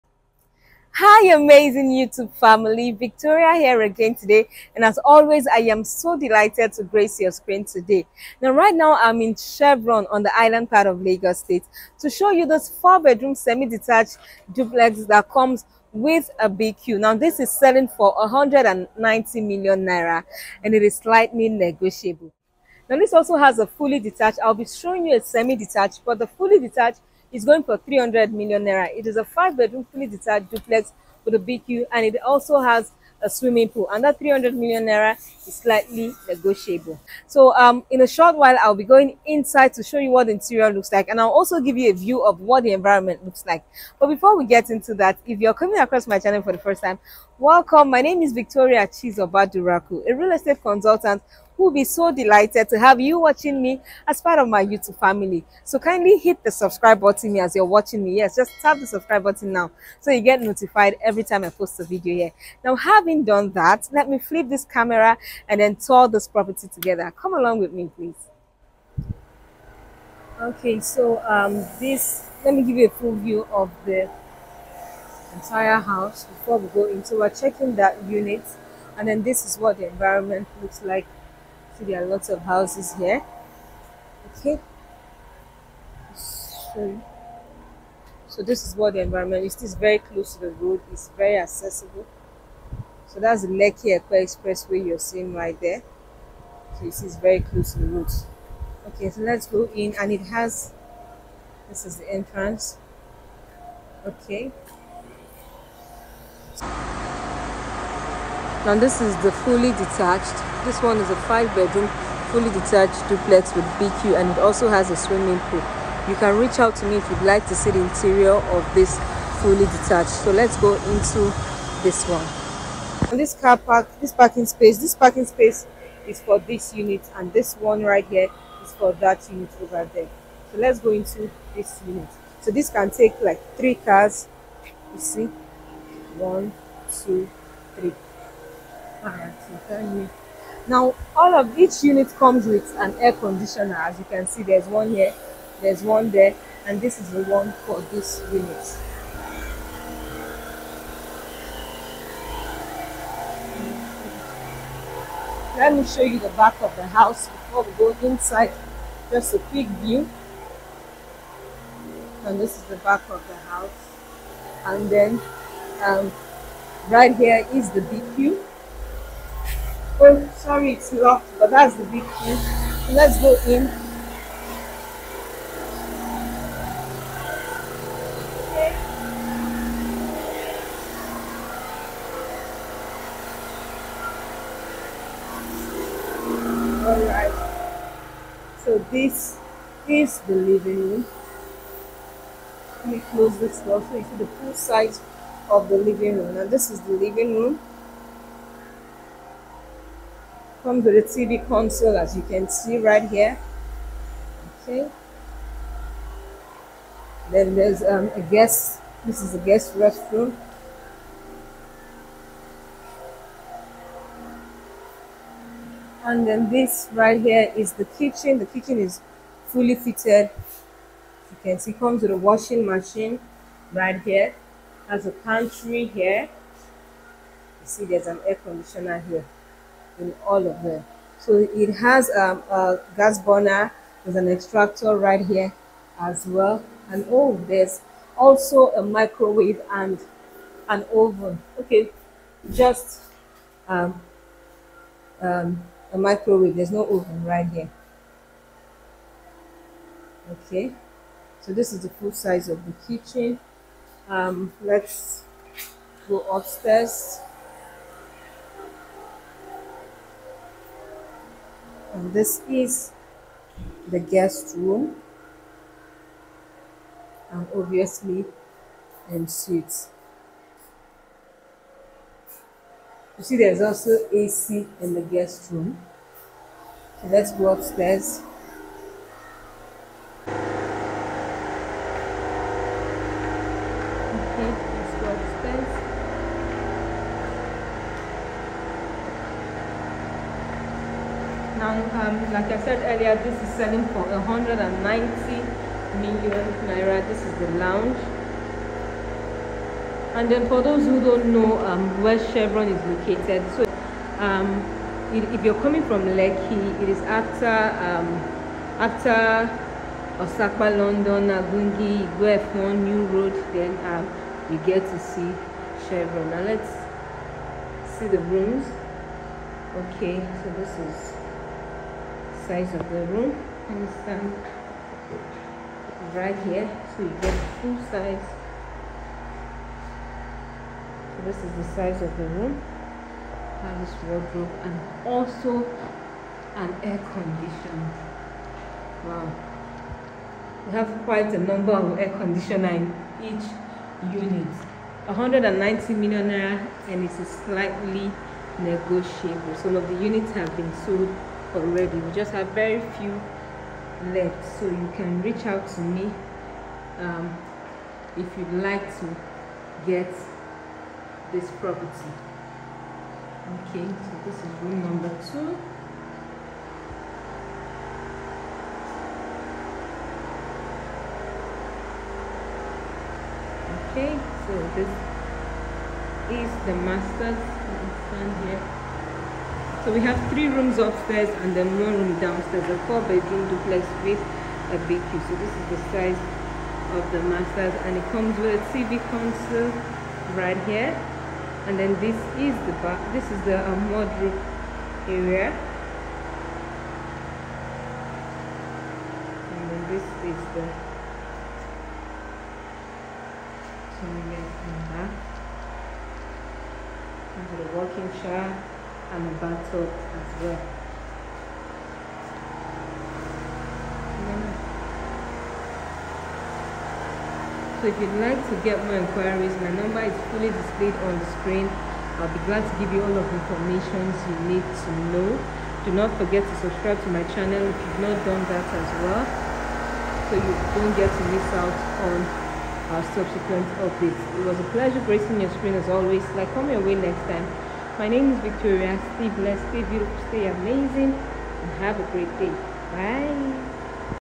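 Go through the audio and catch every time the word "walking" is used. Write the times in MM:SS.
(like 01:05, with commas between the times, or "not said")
06:47.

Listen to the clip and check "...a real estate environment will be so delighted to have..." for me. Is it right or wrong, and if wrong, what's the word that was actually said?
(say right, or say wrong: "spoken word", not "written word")
wrong: "consultant", not "environment".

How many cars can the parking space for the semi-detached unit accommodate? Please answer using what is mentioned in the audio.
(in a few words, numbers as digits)
3.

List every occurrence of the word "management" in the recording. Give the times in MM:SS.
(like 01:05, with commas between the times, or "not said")
not said.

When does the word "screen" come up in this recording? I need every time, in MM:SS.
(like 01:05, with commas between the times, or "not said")
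00:07, 07:01, 07:15.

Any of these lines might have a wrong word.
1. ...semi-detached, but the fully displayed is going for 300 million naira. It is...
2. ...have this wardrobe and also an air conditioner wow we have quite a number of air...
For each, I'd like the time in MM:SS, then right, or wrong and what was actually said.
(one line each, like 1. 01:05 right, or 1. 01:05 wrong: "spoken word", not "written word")
1. 00:25 wrong: "detached", not "displayed"
2. 05:33 right.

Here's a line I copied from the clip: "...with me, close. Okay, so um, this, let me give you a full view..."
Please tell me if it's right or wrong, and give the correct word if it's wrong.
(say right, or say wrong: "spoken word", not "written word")
wrong: "please", not "close".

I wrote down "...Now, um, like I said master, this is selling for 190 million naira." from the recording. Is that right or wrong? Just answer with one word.
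wrong.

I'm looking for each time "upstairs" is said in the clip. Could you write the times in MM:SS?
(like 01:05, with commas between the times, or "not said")
04:16, 04:37, 06:20.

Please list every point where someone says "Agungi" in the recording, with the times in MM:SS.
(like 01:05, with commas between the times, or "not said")
05:11.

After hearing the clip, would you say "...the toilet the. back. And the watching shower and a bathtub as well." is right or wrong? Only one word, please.
wrong.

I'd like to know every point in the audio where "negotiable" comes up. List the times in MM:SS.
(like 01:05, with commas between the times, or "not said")
00:21, 00:36, 05:48.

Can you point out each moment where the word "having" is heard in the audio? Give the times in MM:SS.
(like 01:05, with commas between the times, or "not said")
01:02.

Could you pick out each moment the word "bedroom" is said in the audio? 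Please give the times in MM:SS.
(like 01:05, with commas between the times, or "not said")
00:12, 00:29, 01:51, 06:23.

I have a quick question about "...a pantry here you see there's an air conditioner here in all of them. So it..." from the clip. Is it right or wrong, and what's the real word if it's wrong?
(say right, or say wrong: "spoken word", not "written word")
right.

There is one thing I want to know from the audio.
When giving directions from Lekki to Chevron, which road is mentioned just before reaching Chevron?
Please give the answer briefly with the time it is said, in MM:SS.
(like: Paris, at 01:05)
F1 New Road, at 05:12.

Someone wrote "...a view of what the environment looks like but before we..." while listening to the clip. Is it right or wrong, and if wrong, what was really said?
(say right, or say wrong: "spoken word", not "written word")
right.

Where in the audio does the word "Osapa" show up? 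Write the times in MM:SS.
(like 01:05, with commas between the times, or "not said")
05:10.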